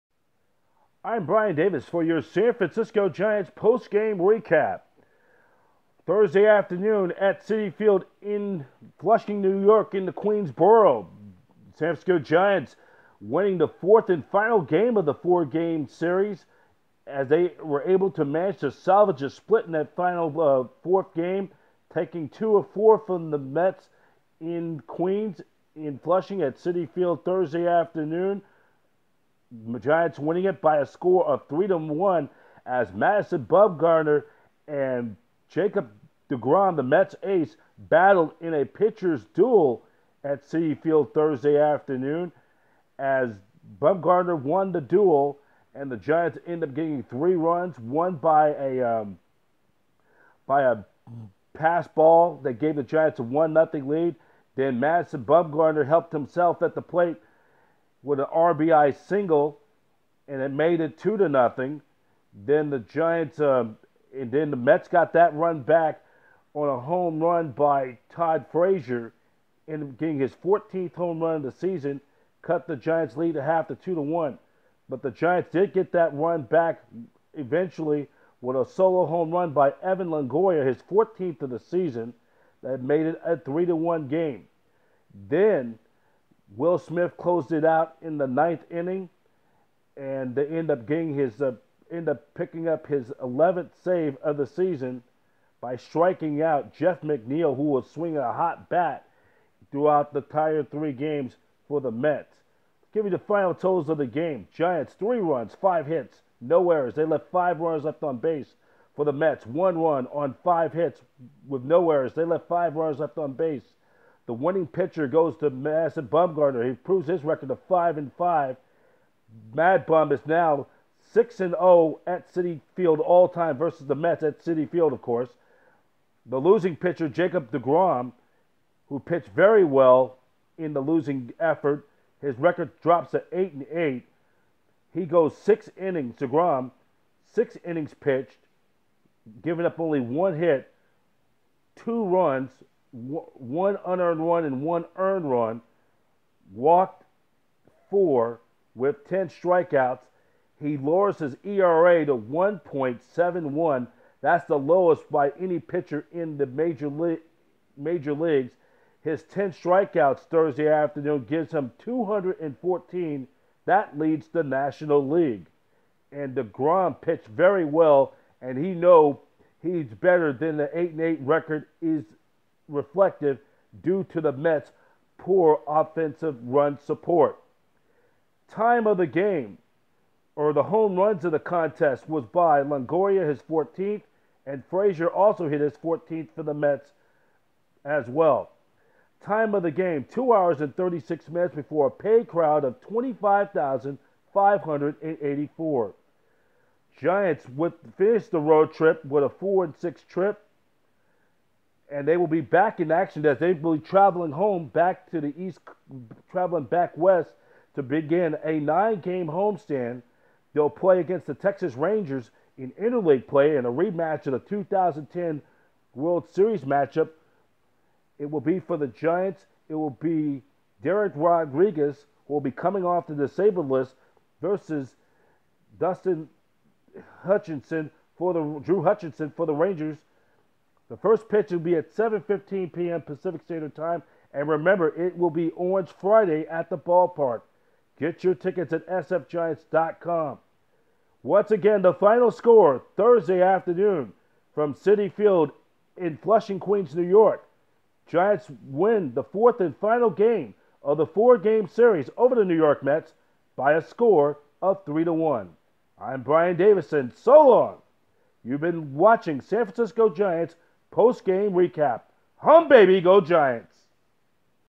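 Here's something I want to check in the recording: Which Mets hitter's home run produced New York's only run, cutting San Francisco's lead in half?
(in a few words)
Todd Frazier.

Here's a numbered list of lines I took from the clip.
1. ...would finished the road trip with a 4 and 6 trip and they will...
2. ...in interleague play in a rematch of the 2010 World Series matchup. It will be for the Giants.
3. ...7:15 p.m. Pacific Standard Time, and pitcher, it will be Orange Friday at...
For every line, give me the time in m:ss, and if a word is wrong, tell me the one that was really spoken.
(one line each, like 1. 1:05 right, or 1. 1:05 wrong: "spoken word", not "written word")
1. 3:17 right
2. 3:32 right
3. 3:51 wrong: "remember", not "pitcher".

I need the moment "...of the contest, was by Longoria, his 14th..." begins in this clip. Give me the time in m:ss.
3:01.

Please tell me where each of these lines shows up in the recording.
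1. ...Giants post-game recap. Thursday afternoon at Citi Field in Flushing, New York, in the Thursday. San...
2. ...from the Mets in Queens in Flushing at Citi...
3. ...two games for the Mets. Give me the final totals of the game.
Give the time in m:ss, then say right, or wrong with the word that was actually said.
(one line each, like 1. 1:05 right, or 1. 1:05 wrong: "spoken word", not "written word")
1. 0:03 wrong: "Queensboro", not "Thursday"
2. 0:23 right
3. 1:40 wrong: "three", not "two".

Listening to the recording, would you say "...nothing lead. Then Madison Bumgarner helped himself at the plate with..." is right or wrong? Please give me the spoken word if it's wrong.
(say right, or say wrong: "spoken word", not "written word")
right.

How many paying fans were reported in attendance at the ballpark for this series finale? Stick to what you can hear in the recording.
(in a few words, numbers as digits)
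25,584.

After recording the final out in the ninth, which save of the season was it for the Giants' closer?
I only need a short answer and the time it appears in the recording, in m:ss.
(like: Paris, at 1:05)
11th, at 1:33.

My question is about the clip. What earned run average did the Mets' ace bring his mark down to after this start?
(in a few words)
1.71.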